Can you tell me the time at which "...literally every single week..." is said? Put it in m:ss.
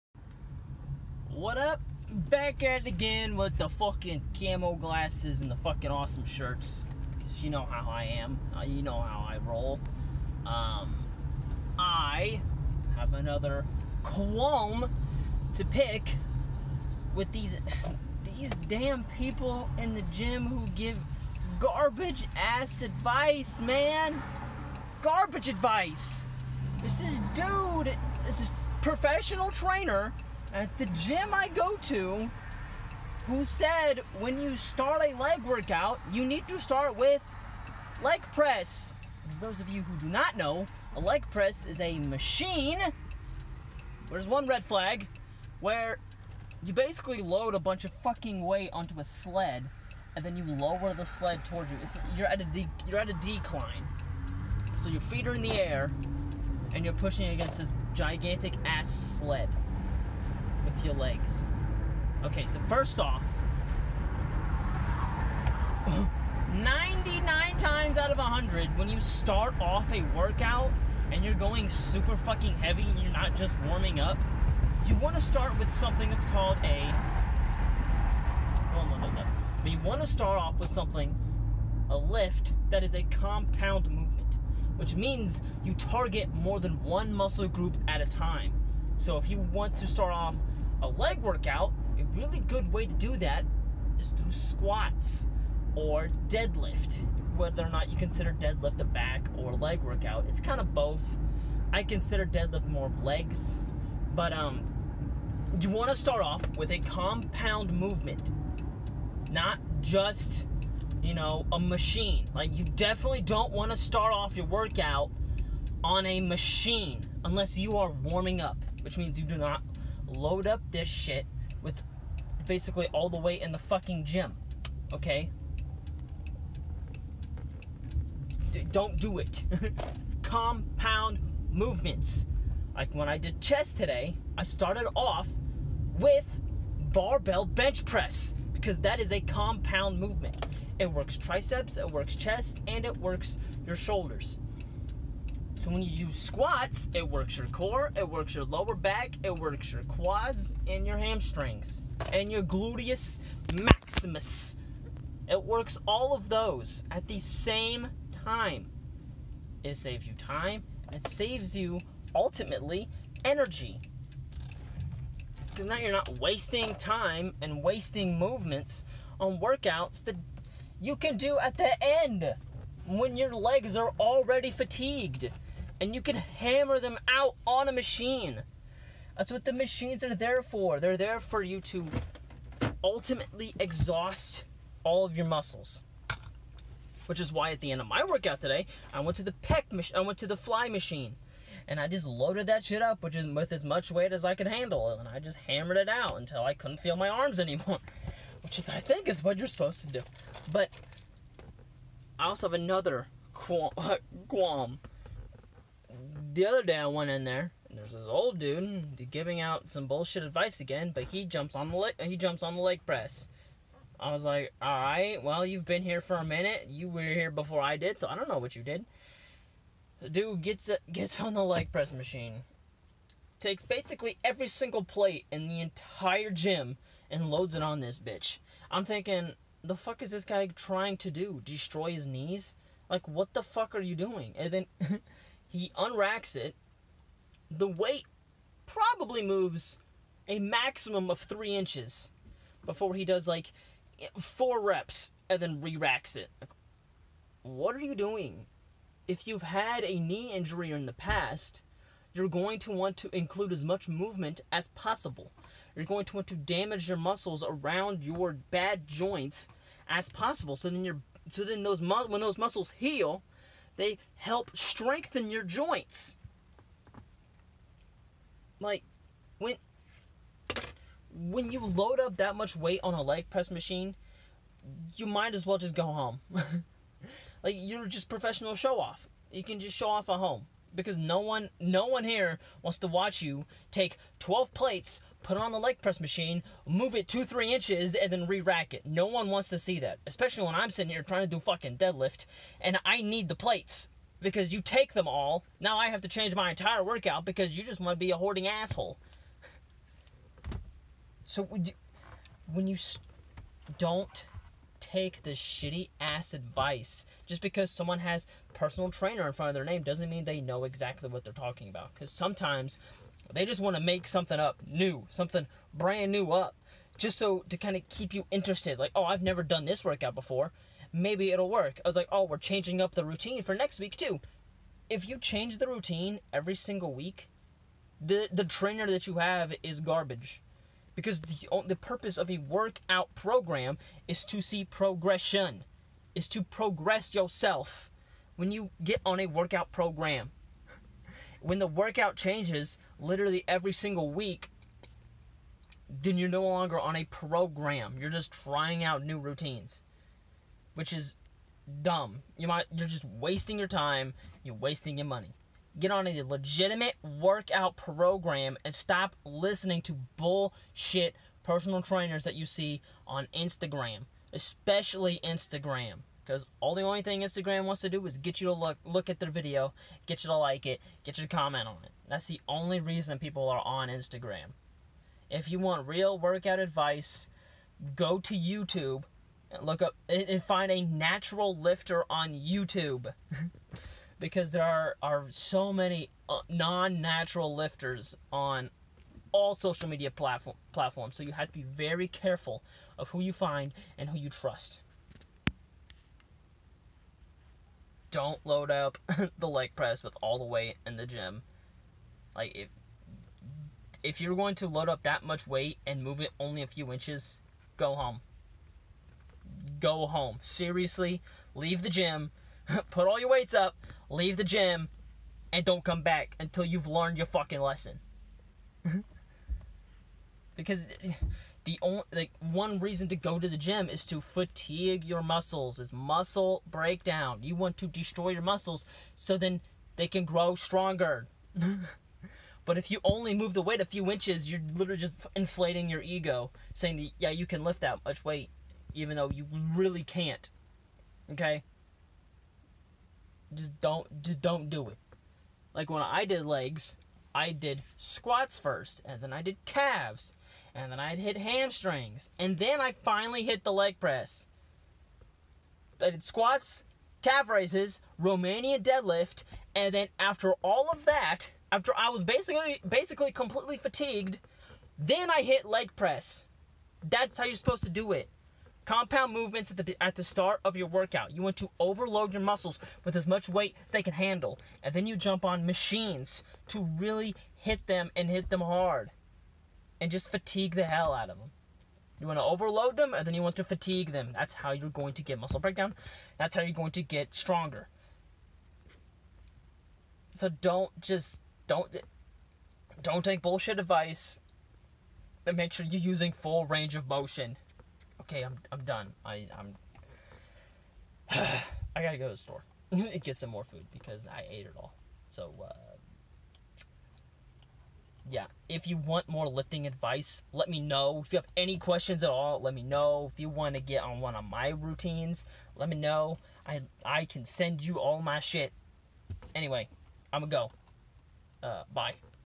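5:42.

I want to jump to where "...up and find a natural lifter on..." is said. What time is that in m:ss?
6:19.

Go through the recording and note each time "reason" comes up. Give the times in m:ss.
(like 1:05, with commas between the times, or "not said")
6:12, 7:02.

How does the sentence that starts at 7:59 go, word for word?
And just fatigue the hell out of them.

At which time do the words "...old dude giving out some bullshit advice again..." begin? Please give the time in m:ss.
3:28.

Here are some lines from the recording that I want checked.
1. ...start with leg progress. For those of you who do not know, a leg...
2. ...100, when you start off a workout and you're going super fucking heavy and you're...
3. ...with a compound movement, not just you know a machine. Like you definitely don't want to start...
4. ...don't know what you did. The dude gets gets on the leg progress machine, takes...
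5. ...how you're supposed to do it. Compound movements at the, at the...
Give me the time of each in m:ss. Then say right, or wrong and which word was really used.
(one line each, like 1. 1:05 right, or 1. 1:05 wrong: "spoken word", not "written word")
1. 0:36 wrong: "press", not "progress"
2. 1:08 right
3. 1:46 right
4. 3:38 wrong: "press", not "progress"
5. 7:47 right.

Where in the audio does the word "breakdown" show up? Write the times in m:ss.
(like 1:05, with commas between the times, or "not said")
7:06, 8:05.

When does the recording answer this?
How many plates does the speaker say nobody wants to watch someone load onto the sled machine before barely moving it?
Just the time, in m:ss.
4:44.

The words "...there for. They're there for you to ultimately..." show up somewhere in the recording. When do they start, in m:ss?
3:00.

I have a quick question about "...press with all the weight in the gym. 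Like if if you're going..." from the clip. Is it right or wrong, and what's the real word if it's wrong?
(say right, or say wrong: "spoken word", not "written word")
right.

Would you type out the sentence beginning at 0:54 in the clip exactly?
So your feet are in the air and you're pushing against this gigantic ass sled with your legs.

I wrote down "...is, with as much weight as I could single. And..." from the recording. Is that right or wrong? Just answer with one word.
wrong.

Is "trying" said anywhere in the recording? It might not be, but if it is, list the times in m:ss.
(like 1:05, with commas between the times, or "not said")
3:50, 4:51, 5:48.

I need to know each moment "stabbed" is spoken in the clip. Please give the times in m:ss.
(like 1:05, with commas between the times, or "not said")
not said.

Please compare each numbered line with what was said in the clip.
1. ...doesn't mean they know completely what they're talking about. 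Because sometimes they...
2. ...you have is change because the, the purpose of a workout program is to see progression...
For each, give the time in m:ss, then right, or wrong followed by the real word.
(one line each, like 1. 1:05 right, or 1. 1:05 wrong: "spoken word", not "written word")
1. 5:09 wrong: "exactly", not "completely"
2. 5:29 wrong: "garbage", not "change".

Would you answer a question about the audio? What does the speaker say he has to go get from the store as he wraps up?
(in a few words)
Food.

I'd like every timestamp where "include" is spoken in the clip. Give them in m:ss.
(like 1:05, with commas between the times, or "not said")
4:13.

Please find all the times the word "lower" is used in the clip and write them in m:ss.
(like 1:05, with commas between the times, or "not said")
0:50, 2:28.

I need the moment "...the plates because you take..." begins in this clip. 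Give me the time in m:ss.
4:53.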